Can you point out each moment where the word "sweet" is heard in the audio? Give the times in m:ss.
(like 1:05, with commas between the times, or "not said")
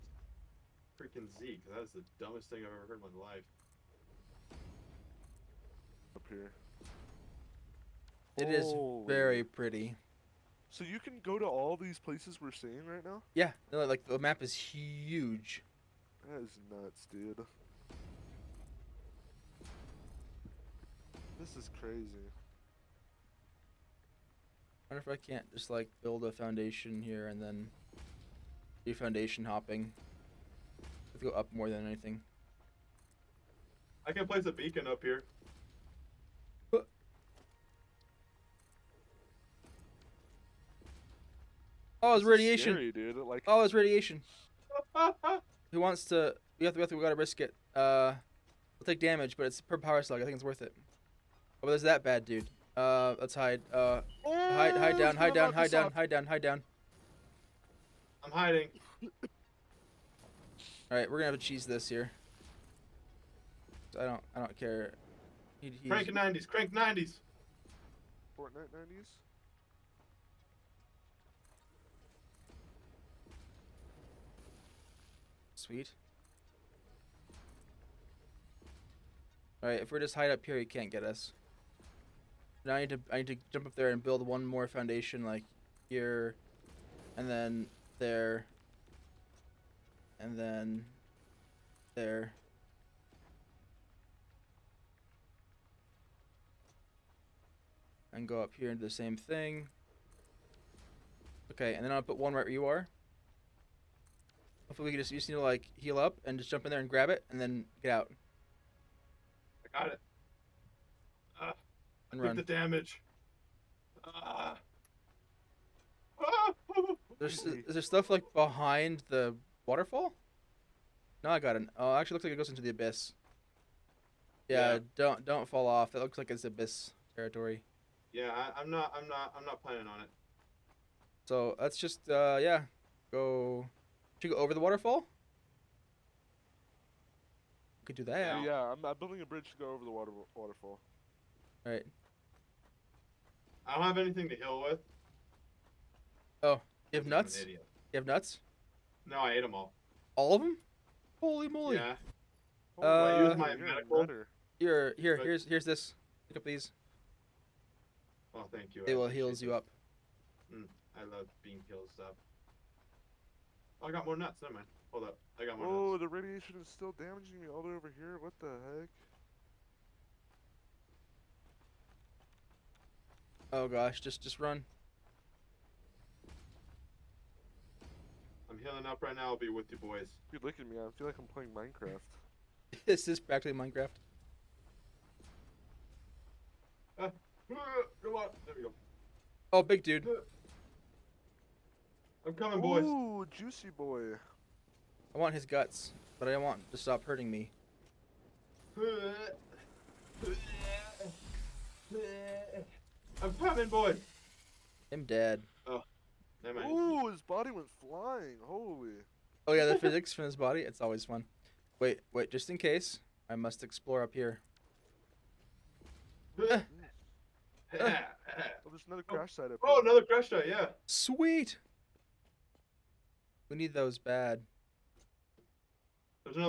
1:15, 3:40.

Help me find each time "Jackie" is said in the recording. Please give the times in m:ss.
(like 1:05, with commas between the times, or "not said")
not said.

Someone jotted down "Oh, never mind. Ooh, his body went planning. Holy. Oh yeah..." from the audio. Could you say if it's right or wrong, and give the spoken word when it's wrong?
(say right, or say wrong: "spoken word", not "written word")
wrong: "flying", not "planning".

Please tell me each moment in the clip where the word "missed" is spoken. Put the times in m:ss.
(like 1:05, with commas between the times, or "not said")
not said.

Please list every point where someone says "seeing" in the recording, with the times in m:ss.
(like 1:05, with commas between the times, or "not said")
0:12.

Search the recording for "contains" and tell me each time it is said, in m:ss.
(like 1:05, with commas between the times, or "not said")
not said.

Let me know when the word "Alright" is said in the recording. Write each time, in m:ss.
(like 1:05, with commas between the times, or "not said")
1:19.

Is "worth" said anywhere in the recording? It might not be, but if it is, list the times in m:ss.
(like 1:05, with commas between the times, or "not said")
0:50.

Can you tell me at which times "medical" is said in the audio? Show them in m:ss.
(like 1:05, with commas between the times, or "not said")
2:33.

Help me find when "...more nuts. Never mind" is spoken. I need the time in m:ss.
2:44.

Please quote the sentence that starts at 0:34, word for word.
I can place a beacon up here.